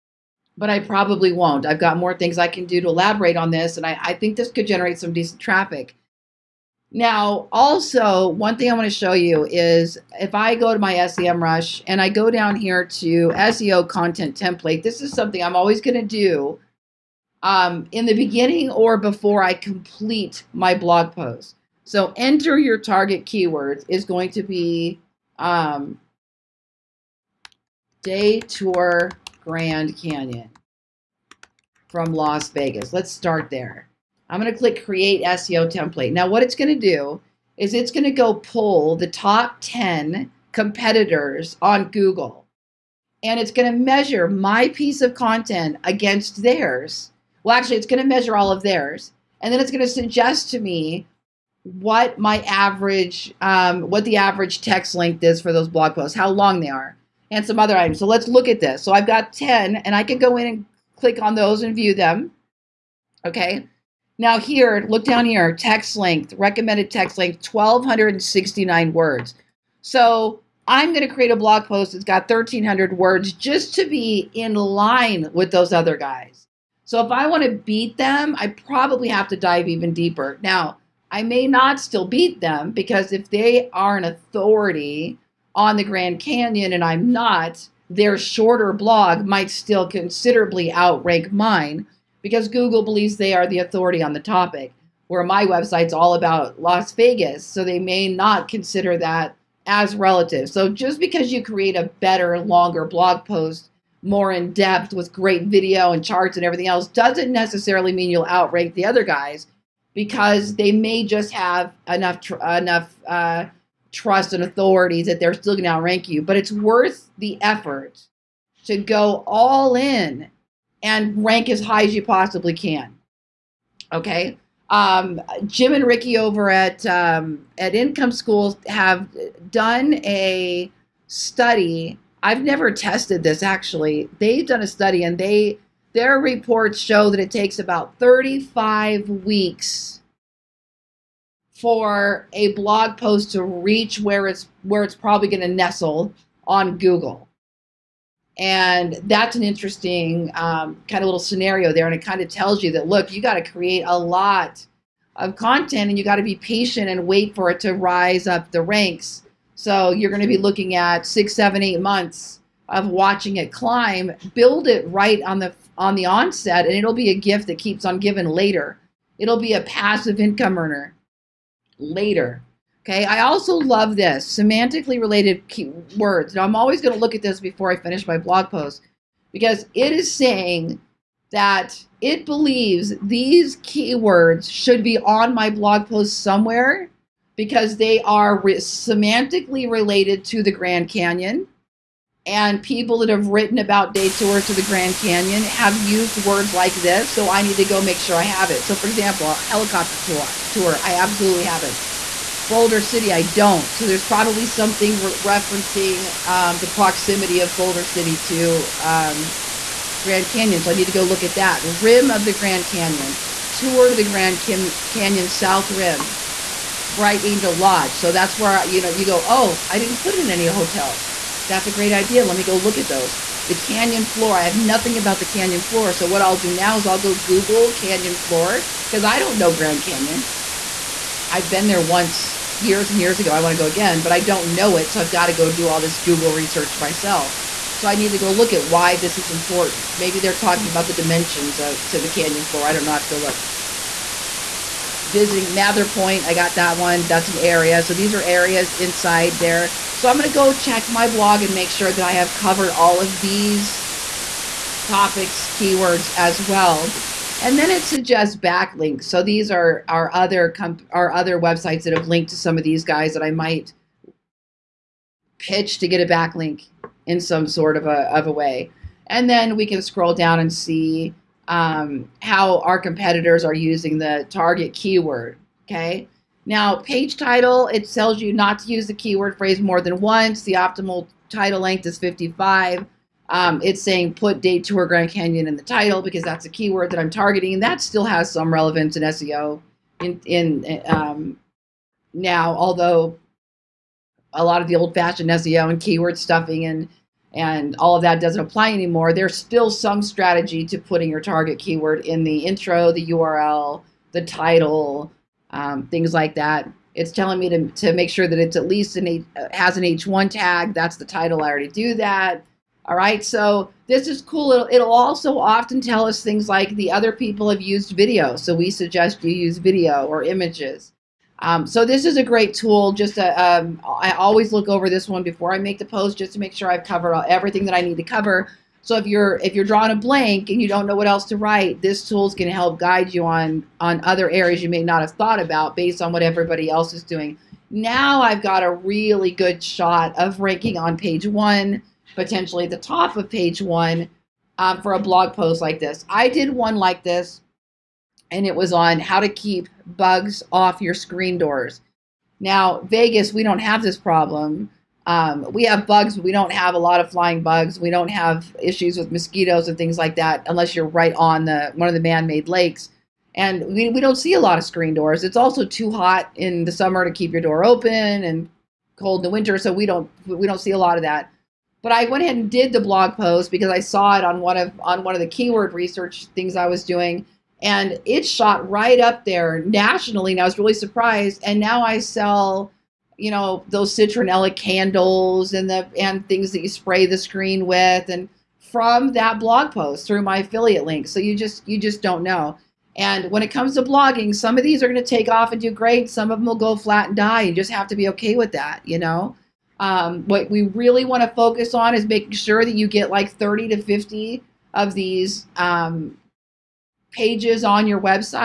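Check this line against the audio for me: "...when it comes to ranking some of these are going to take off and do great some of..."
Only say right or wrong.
wrong.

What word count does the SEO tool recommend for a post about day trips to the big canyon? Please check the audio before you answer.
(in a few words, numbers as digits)
1,269 words.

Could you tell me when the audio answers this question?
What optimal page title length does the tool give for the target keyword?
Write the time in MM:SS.
04:41.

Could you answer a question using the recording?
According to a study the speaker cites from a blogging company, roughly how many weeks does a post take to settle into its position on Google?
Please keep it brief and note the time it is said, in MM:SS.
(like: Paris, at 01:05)
35 weeks, at 02:17.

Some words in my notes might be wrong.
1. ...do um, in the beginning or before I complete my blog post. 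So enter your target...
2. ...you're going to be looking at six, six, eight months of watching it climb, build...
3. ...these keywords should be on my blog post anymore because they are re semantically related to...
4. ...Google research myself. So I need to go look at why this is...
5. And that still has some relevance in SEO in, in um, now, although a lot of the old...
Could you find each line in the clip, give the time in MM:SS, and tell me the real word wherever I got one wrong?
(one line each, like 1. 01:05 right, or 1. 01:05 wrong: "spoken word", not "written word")
1. 00:16 right
2. 02:39 wrong: "seven", not "six"
3. 03:02 wrong: "somewhere", not "anymore"
4. 03:55 right
5. 04:47 right.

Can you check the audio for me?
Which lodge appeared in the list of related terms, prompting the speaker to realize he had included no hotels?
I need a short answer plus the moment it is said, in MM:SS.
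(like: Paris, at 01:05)
Bright Angel Lodge, at 03:36.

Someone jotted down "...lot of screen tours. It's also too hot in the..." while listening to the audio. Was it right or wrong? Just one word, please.
wrong.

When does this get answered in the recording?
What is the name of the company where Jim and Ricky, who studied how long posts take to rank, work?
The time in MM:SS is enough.
02:07.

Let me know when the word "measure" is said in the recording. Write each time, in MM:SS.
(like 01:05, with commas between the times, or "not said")
00:43, 00:48.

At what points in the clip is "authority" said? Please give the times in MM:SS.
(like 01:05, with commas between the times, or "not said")
01:24, 01:33, 01:54.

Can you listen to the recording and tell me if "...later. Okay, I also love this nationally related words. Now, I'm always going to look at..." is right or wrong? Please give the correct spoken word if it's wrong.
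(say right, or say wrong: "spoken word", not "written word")
wrong: "semantically", not "nationally".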